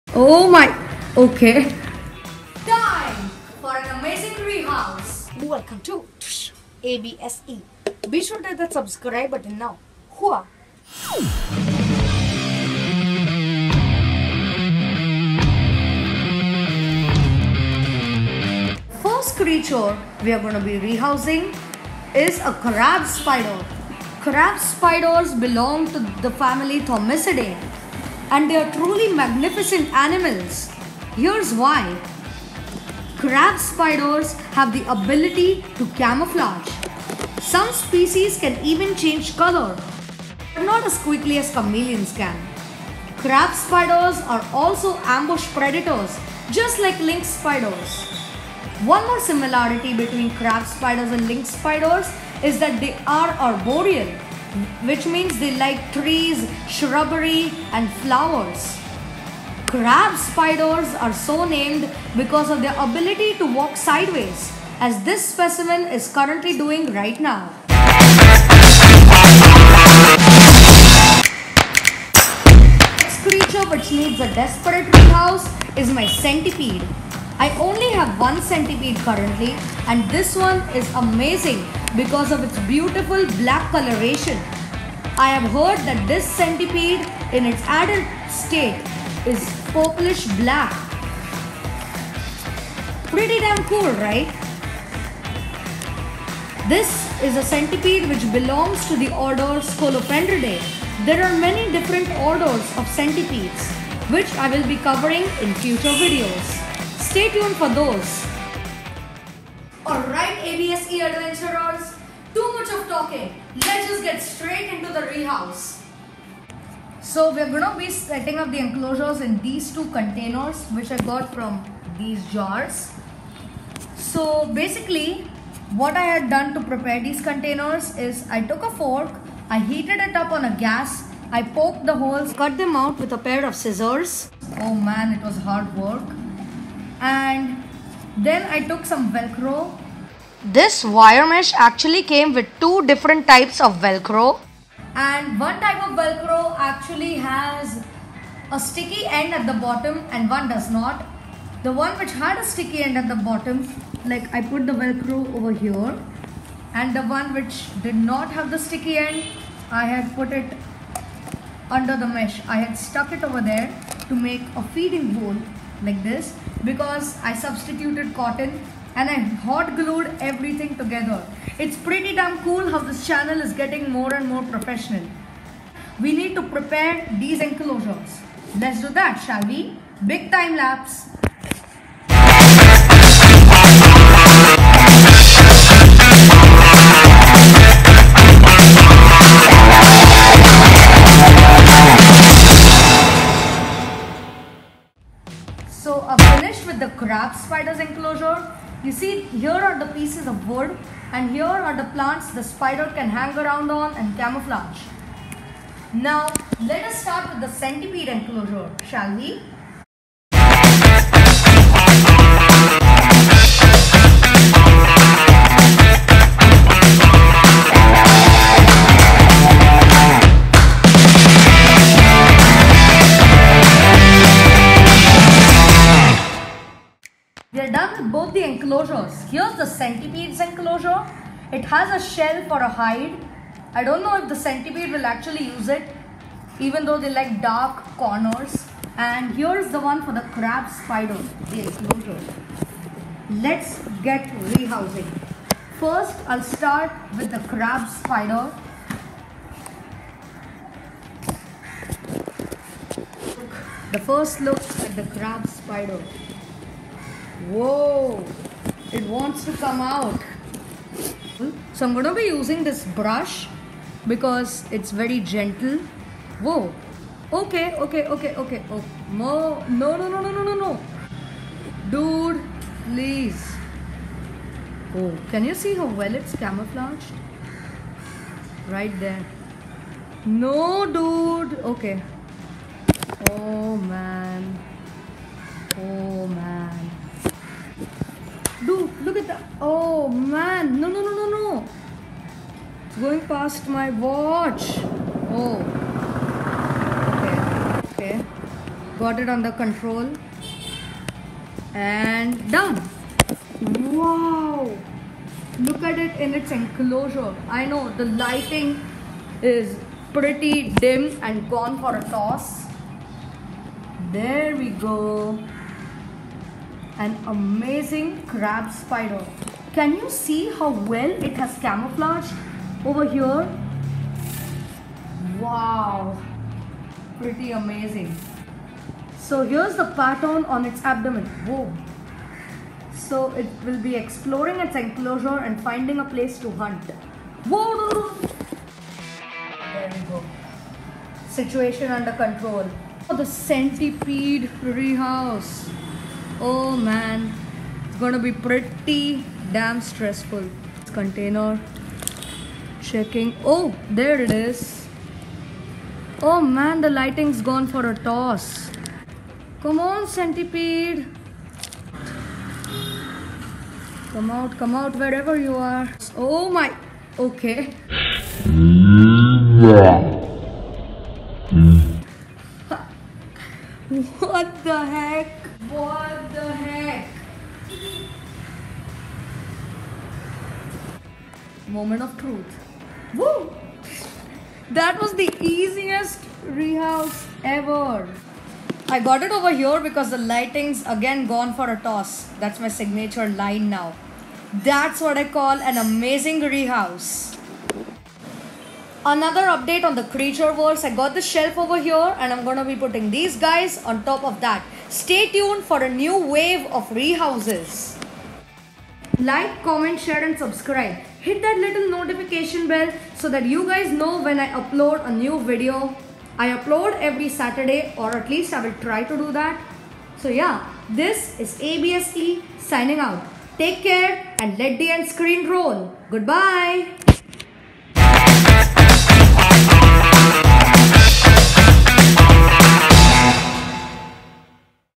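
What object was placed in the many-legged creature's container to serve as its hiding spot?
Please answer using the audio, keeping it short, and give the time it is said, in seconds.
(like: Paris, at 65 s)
a shell, at 232 s.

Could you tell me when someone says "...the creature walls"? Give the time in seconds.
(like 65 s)
399 s.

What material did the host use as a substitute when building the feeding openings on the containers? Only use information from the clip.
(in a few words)
cotton.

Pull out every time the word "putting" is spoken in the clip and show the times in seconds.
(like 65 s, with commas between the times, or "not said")
402 s.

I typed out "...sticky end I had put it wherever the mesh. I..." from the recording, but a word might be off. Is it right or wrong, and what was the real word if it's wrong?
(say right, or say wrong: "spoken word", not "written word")
wrong: "under", not "wherever".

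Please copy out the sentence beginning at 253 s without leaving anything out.
The first look at the crab spider.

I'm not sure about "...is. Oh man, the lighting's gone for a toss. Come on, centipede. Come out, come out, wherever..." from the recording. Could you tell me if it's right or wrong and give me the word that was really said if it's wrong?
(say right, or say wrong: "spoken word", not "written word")
right.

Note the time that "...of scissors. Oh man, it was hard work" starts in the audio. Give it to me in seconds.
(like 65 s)
133 s.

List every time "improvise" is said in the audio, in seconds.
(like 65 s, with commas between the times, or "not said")
not said.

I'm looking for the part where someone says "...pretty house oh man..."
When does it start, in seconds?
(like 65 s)
344 s.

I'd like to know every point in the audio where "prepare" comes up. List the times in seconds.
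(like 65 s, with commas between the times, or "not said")
126 s, 176 s.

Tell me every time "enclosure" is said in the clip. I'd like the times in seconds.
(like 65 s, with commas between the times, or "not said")
118 s, 177 s, 197 s, 208 s, 230 s, 241 s, 306 s, 334 s.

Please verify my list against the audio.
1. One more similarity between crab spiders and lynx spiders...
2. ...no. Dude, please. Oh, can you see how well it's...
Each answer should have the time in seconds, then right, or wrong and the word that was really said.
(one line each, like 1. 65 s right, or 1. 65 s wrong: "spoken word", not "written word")
1. 48 s right
2. 270 s right.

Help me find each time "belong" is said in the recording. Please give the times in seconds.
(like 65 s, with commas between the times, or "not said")
25 s, 98 s.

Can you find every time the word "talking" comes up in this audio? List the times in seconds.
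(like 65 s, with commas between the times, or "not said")
112 s.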